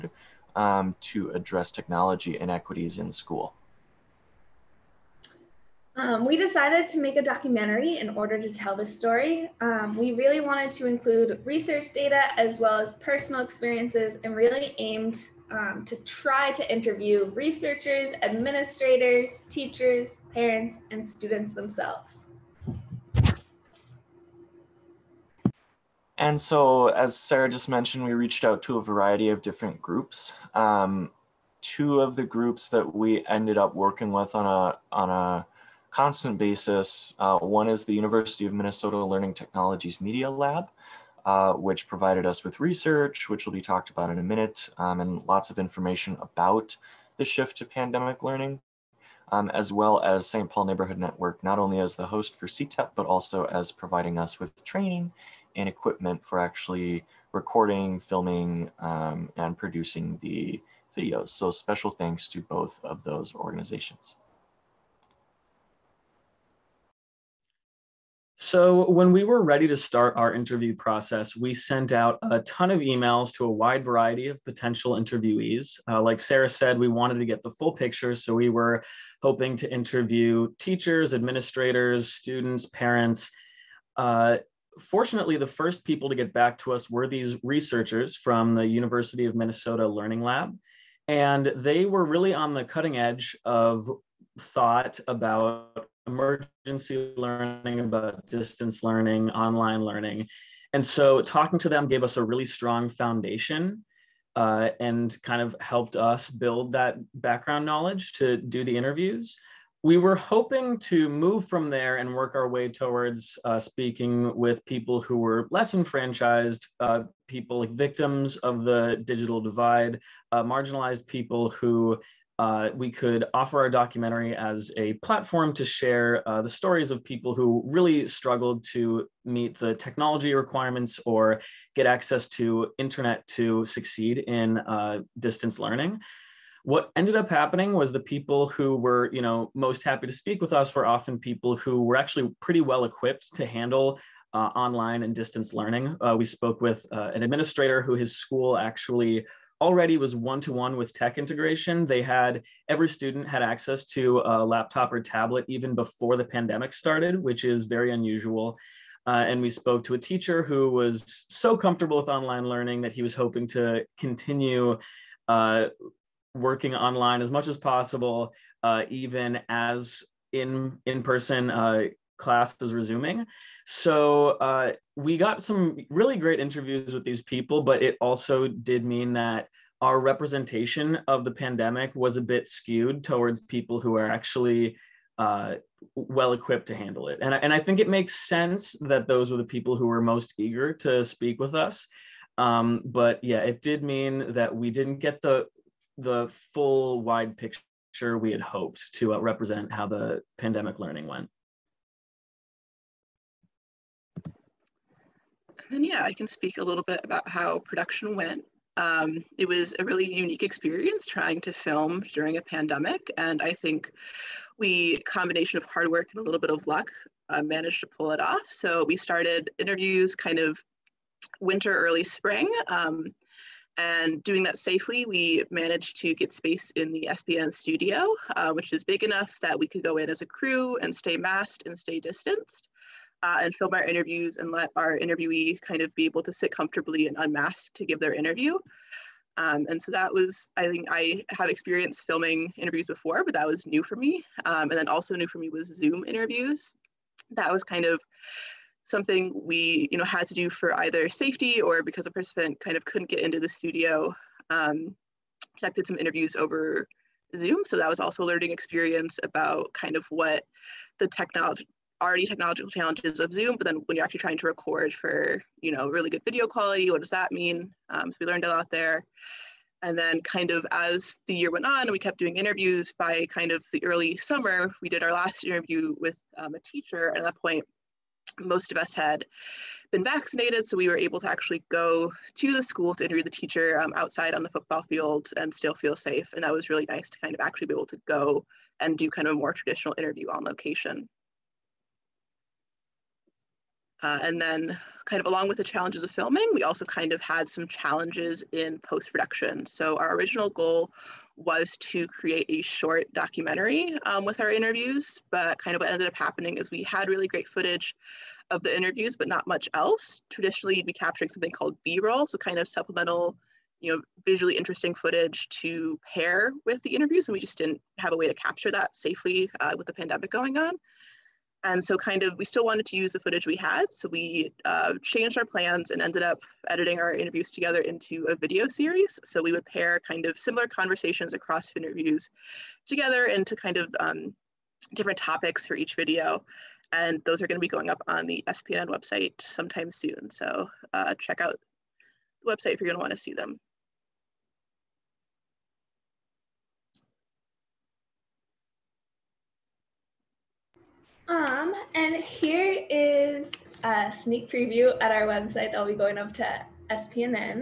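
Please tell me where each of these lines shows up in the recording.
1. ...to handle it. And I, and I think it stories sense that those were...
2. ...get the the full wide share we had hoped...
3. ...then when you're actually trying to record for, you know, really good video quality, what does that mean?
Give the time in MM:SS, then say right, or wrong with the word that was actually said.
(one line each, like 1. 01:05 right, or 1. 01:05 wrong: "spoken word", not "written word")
1. 03:06 wrong: "makes", not "stories"
2. 03:14 wrong: "picture", not "share"
3. 04:23 right.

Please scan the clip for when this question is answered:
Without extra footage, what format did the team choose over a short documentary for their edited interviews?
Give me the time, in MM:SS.
05:28.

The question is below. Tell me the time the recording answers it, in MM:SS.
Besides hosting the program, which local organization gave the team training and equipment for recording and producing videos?
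00:50.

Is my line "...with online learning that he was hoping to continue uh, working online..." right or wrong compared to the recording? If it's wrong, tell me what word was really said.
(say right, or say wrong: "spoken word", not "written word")
right.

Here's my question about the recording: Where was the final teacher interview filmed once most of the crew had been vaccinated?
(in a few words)
the football field.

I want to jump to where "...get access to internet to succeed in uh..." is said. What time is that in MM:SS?
02:11.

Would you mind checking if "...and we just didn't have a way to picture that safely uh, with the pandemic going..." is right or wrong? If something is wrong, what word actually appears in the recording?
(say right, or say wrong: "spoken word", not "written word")
wrong: "capture", not "picture".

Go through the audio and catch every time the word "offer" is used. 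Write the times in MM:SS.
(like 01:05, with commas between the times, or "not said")
02:03.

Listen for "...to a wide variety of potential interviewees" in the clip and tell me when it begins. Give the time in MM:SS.
01:13.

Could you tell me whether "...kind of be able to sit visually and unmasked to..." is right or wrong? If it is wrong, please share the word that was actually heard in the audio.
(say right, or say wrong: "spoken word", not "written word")
wrong: "comfortably", not "visually".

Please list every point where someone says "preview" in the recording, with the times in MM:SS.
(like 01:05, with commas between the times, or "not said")
05:54.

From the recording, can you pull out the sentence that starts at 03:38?
So we started interviews kind of winter, early spring.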